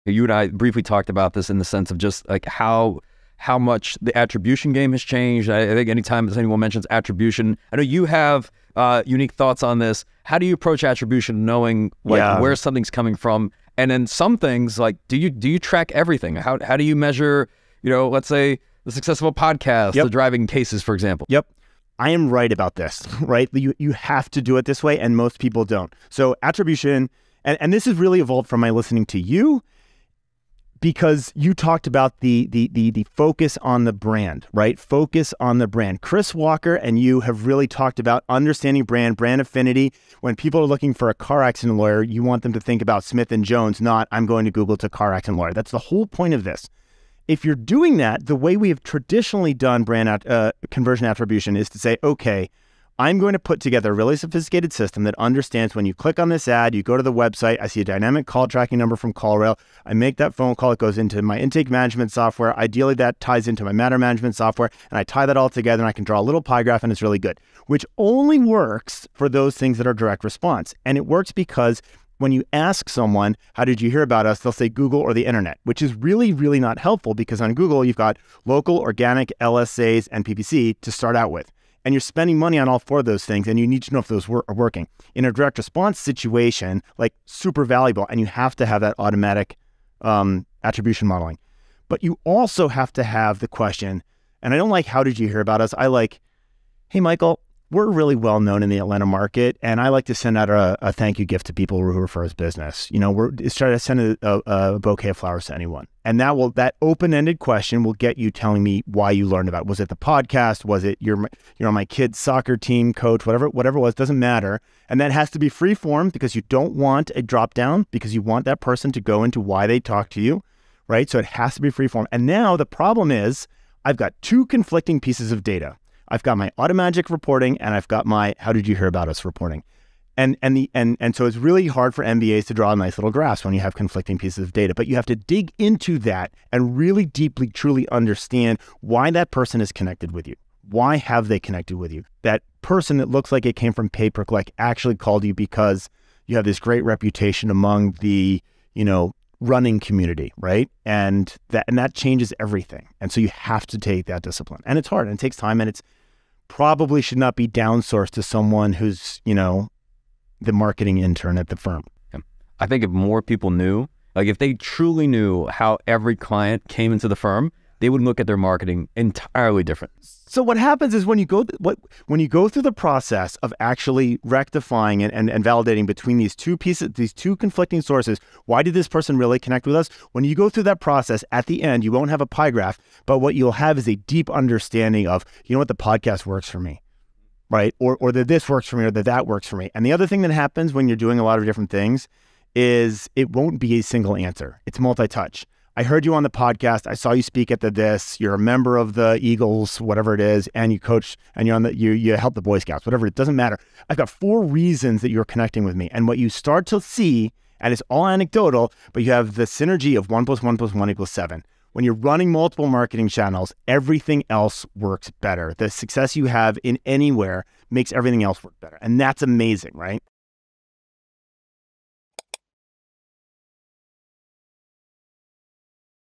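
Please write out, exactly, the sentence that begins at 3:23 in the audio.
I've got four reasons that you're connecting with me.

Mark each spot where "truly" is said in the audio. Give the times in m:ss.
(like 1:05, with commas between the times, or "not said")
2:17, 2:44.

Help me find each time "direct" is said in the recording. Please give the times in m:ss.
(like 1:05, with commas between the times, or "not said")
1:09, 1:25.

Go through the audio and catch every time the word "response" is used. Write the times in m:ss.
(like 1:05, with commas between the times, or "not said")
1:10, 1:25.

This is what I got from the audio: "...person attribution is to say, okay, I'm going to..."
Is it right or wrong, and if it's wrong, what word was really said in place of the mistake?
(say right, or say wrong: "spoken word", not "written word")
wrong: "conversion", not "person".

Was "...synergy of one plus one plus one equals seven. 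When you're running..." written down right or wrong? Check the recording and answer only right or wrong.
right.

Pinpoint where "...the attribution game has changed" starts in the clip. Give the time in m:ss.
0:04.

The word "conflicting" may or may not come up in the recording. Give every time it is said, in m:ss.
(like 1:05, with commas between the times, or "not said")
2:04, 2:13, 2:57.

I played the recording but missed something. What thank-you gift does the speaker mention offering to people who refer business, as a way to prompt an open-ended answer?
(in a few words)
A bouquet of flowers.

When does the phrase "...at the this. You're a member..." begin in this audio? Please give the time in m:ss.
3:17.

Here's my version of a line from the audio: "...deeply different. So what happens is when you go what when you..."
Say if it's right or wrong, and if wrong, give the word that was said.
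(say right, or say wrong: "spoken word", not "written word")
wrong: "entirely", not "deeply".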